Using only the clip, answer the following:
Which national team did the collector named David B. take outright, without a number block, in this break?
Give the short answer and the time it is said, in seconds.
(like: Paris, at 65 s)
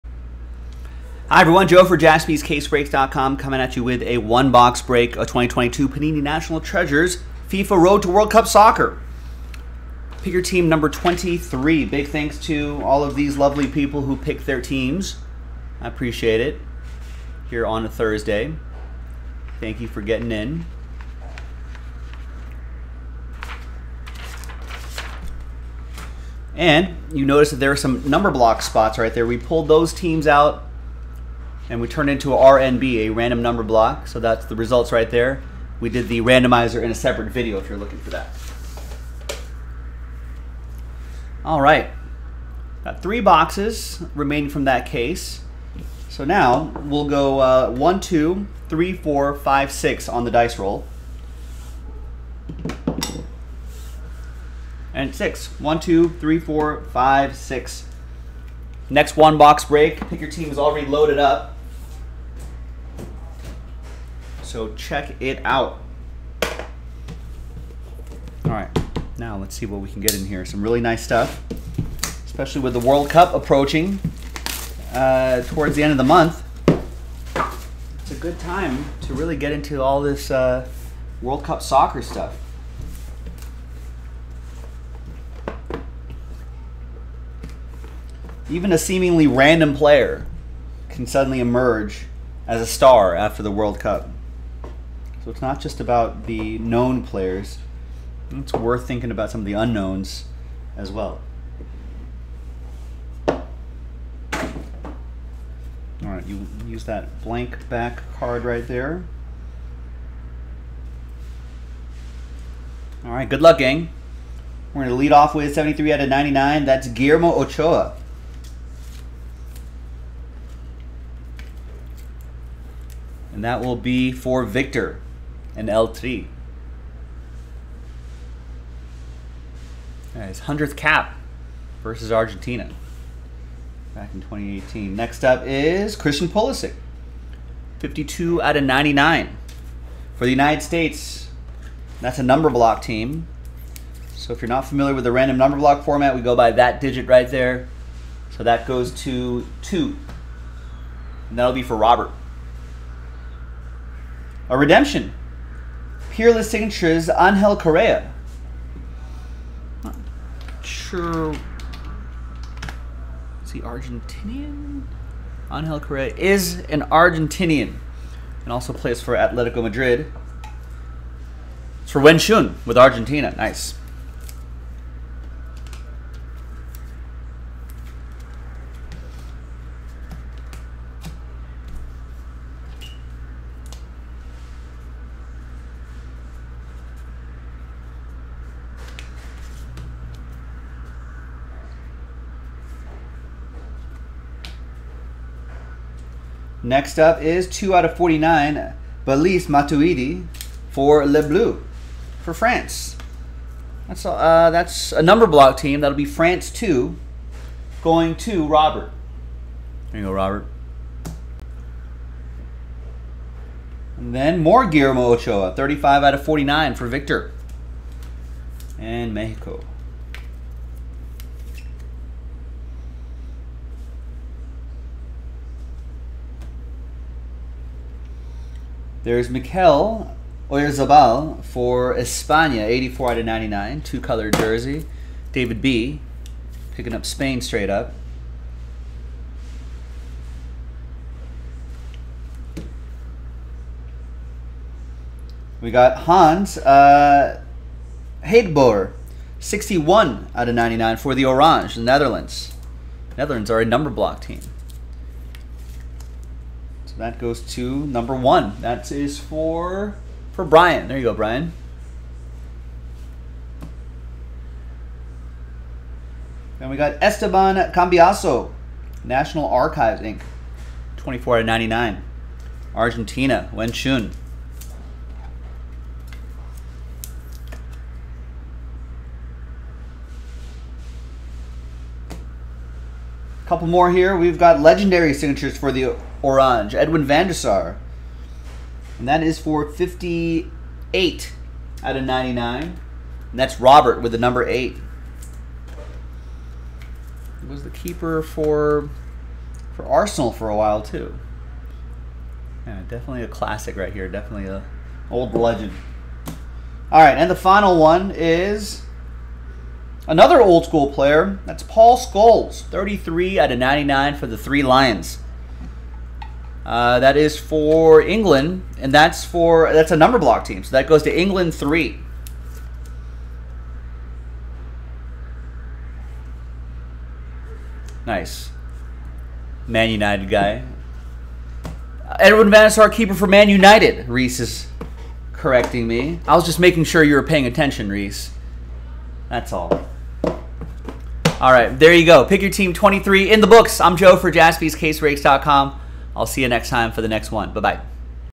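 Spain, at 237 s.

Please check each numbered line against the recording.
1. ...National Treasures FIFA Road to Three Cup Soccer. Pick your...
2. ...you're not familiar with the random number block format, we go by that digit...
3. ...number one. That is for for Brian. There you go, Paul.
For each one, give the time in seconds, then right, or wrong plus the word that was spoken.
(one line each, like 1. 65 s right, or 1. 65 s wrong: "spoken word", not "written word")
1. 6 s wrong: "World", not "Three"
2. 144 s right
3. 257 s wrong: "Brian", not "Paul".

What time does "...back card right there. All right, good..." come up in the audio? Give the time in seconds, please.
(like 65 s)
107 s.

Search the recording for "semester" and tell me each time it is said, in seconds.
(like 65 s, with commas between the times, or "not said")
not said.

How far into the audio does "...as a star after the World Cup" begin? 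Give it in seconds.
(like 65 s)
92 s.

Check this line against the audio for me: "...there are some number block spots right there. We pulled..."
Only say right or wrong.
right.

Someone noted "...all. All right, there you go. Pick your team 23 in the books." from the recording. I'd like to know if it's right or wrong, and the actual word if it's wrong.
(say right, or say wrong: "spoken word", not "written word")
right.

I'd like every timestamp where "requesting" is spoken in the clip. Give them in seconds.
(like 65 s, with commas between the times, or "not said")
not said.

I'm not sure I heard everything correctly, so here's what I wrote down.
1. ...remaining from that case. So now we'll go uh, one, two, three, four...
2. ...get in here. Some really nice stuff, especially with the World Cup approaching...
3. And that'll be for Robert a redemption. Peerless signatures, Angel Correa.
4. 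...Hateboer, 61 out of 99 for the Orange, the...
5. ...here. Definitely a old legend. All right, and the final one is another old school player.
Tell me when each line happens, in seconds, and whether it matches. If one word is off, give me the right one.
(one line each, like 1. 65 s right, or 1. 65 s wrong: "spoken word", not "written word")
1. 44 s right
2. 70 s right
3. 151 s right
4. 248 s right
5. 303 s right.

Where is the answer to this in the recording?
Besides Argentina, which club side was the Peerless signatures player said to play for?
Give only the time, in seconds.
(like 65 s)
169 s.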